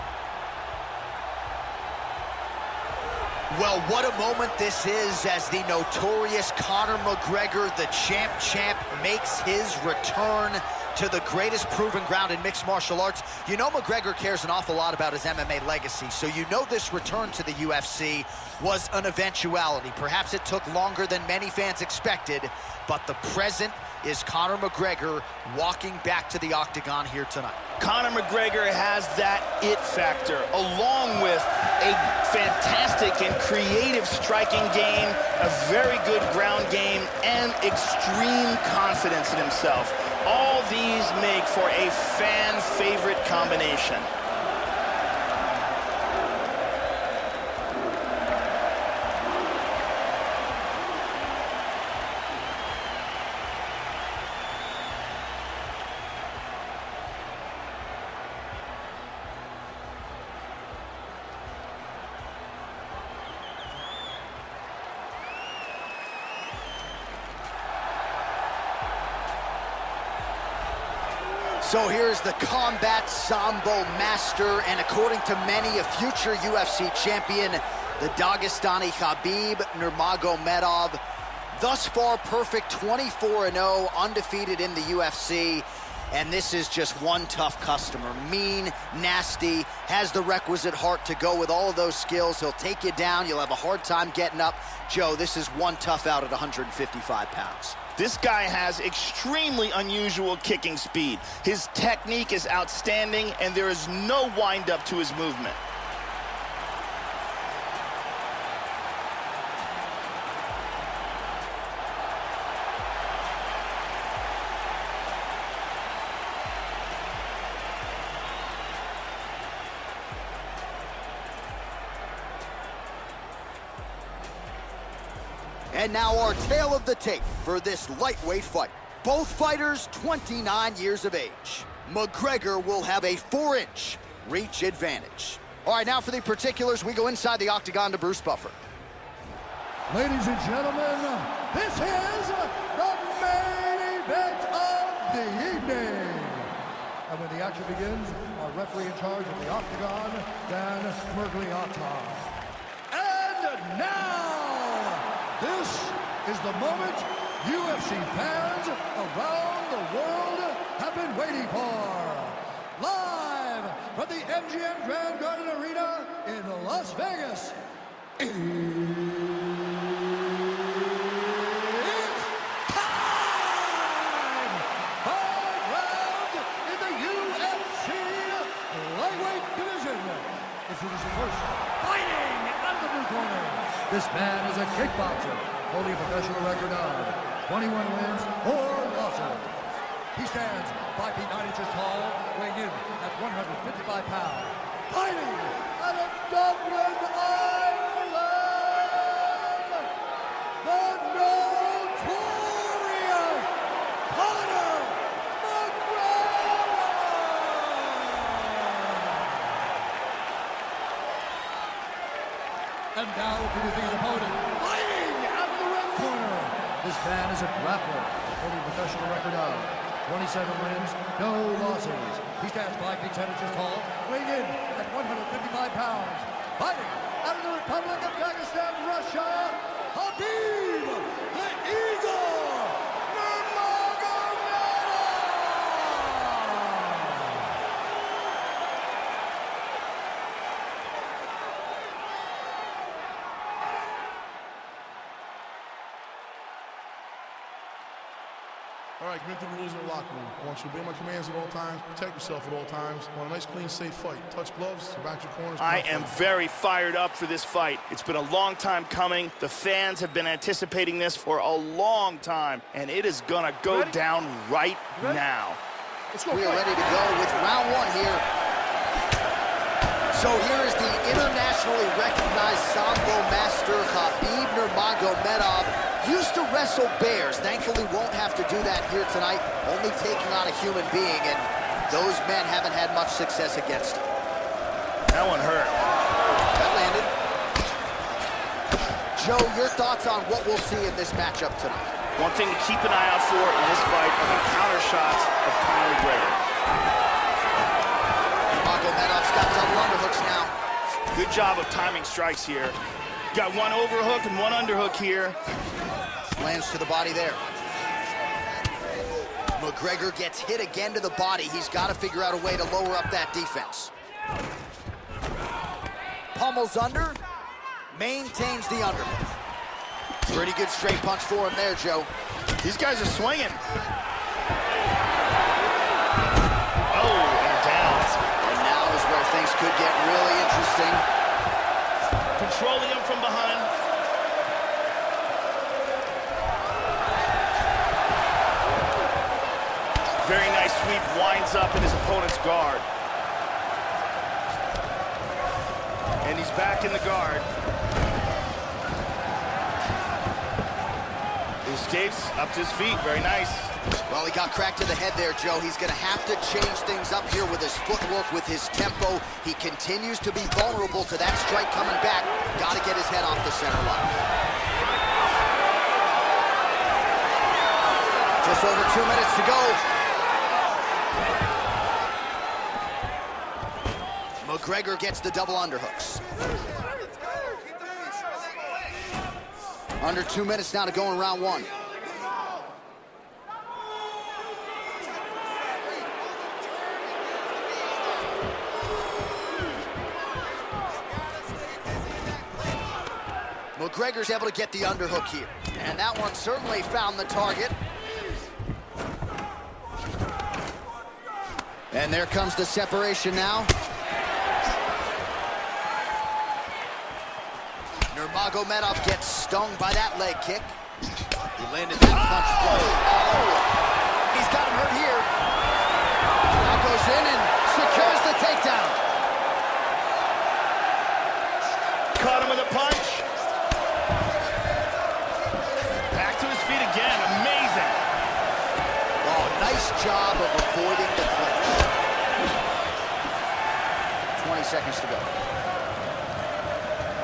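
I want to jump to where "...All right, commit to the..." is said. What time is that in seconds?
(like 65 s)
249 s.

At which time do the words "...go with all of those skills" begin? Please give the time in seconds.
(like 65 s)
91 s.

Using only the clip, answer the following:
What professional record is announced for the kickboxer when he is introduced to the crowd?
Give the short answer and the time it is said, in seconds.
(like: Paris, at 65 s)
21 wins, 4 losses, at 187 s.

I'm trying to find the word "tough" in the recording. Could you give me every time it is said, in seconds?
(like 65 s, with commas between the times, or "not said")
87 s, 95 s.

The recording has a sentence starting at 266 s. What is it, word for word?
Go, we are ready to go with round one here.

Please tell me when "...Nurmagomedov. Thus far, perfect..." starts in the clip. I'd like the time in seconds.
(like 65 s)
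79 s.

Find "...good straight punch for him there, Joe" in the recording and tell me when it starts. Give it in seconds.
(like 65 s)
320 s.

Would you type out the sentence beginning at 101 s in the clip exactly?
His technique is outstanding, and there is no windup to his movement.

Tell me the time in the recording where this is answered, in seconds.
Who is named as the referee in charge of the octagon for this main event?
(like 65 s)
150 s.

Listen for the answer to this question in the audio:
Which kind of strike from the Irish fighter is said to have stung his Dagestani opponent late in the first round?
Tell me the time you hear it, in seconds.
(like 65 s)
410 s.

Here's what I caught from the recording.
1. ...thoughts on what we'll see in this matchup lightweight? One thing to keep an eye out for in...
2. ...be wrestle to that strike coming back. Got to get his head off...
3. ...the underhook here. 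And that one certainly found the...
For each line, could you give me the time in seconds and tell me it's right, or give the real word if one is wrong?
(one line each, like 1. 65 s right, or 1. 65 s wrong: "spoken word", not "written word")
1. 289 s wrong: "tonight", not "lightweight"
2. 360 s wrong: "vulnerable", not "wrestle"
3. 394 s right.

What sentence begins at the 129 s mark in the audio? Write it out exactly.
Both fighters 29 years of age.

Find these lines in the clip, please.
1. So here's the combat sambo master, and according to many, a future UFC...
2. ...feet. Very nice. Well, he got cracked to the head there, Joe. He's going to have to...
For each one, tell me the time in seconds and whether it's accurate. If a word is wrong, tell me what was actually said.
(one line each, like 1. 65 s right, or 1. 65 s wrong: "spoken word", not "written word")
1. 71 s right
2. 352 s right.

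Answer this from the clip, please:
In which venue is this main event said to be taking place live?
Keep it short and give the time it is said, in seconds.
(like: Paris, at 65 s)
MGM Grand Garden Arena, at 164 s.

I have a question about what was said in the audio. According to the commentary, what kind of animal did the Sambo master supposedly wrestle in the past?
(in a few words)
Bears.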